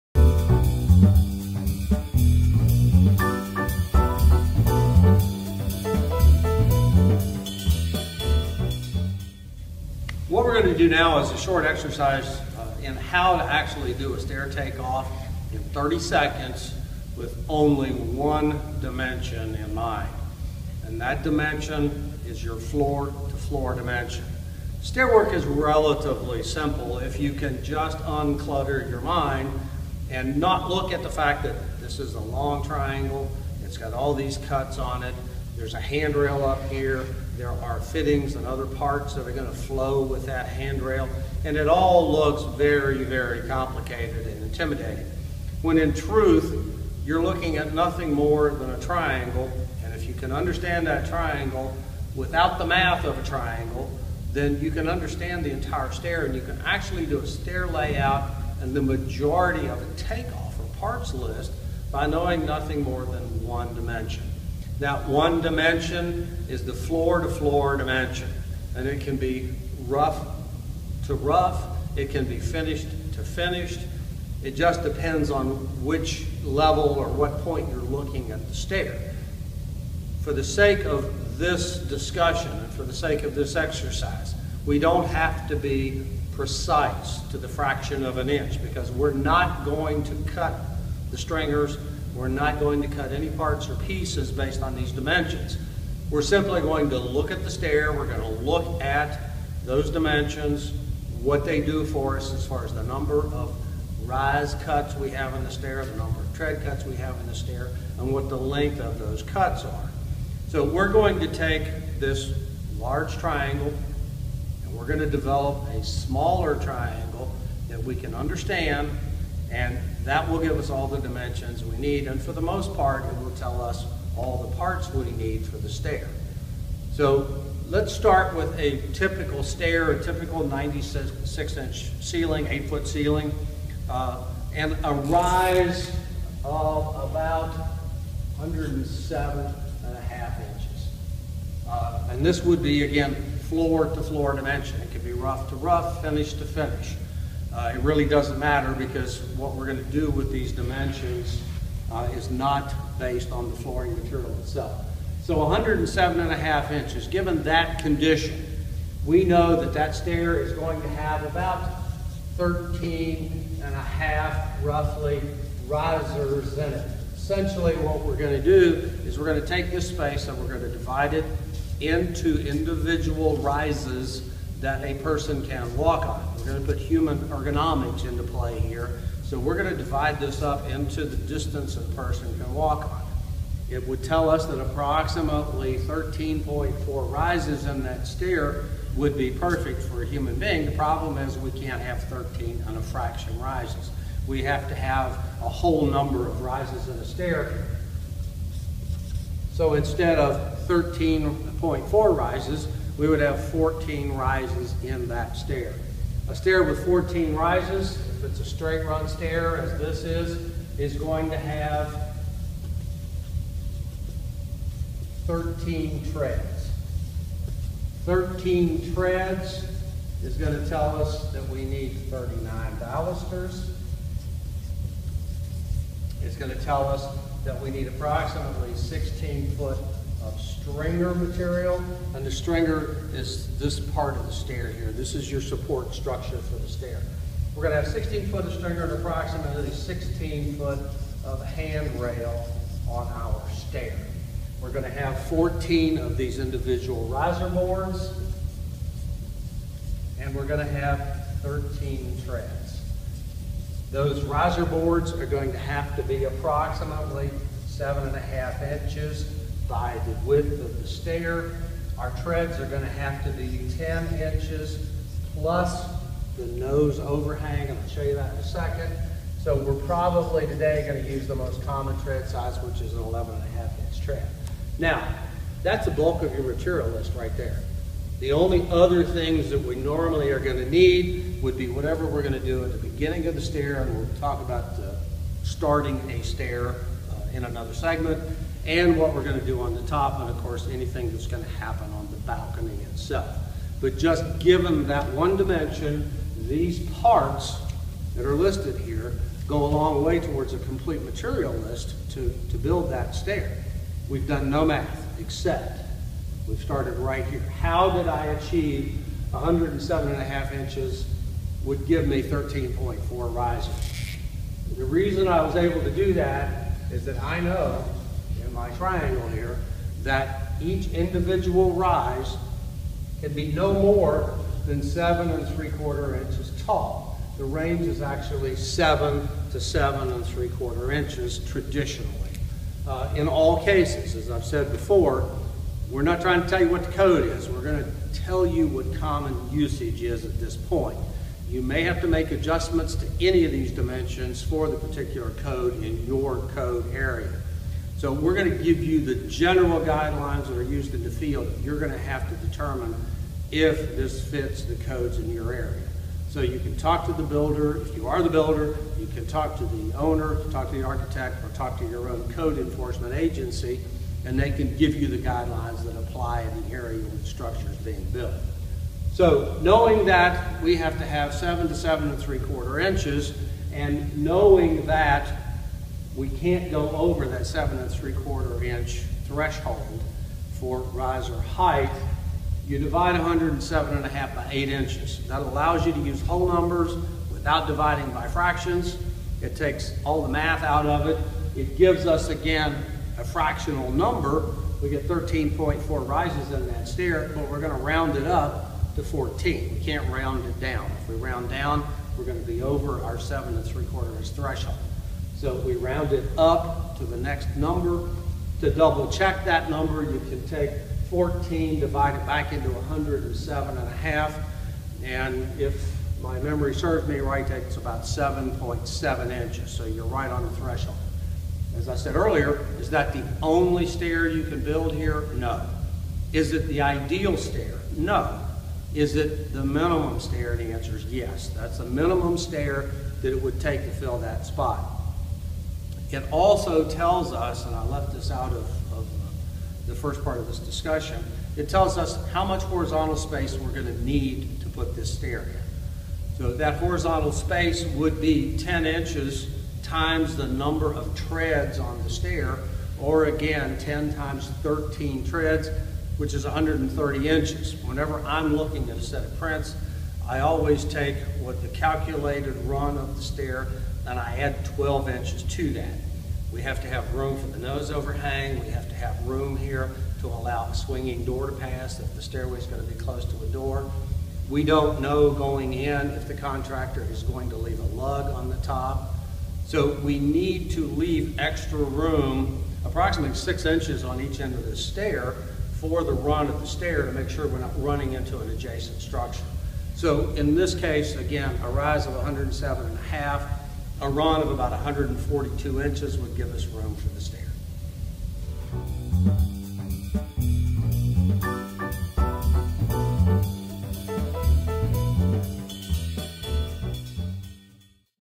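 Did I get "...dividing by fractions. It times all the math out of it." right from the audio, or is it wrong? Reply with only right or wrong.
wrong.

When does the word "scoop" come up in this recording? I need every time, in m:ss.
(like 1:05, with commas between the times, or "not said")
not said.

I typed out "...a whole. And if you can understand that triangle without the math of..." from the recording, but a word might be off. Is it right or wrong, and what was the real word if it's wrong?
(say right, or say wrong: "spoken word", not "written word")
wrong: "triangle", not "whole".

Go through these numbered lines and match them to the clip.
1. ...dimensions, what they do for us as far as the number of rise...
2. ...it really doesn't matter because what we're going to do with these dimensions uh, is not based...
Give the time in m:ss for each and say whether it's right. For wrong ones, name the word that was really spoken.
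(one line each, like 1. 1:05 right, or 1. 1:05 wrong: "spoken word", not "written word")
1. 1:39 right
2. 2:27 right.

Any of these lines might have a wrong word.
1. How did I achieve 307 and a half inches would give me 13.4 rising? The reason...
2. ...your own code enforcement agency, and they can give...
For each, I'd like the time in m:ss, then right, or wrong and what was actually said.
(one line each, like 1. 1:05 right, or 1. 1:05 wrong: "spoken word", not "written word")
1. 5:07 wrong: "107", not "307"
2. 6:01 right.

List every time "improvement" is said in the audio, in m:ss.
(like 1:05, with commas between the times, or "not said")
not said.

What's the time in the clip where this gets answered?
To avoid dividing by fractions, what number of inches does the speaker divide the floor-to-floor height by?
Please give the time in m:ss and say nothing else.
6:24.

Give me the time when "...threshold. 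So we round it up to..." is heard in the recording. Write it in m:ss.
6:44.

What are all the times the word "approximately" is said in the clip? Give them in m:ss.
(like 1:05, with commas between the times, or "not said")
3:04, 3:47, 3:58, 4:16, 8:02.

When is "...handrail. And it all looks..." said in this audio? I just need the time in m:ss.
0:40.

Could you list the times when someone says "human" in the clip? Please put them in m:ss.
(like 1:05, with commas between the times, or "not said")
2:56, 3:10.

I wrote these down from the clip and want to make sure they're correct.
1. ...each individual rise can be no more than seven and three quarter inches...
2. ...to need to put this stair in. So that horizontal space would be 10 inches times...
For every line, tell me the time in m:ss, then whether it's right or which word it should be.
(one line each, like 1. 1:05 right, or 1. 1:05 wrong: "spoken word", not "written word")
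1. 5:20 right
2. 7:23 right.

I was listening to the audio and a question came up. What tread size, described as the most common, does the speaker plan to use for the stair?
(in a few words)
11.5 inch.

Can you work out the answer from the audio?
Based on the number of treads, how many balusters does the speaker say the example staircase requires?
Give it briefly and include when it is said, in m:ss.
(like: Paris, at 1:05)
39, at 3:42.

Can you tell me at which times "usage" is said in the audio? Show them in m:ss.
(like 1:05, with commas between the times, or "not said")
5:39.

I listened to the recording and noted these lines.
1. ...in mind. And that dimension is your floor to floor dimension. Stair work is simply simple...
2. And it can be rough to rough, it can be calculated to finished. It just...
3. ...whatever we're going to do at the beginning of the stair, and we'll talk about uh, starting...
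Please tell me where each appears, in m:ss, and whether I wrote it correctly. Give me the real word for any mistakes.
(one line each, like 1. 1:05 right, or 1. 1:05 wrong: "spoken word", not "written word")
1. 0:19 wrong: "relatively", not "simply"
2. 1:08 wrong: "finished", not "calculated"
3. 4:41 right.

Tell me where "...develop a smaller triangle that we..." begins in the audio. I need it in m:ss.
1:55.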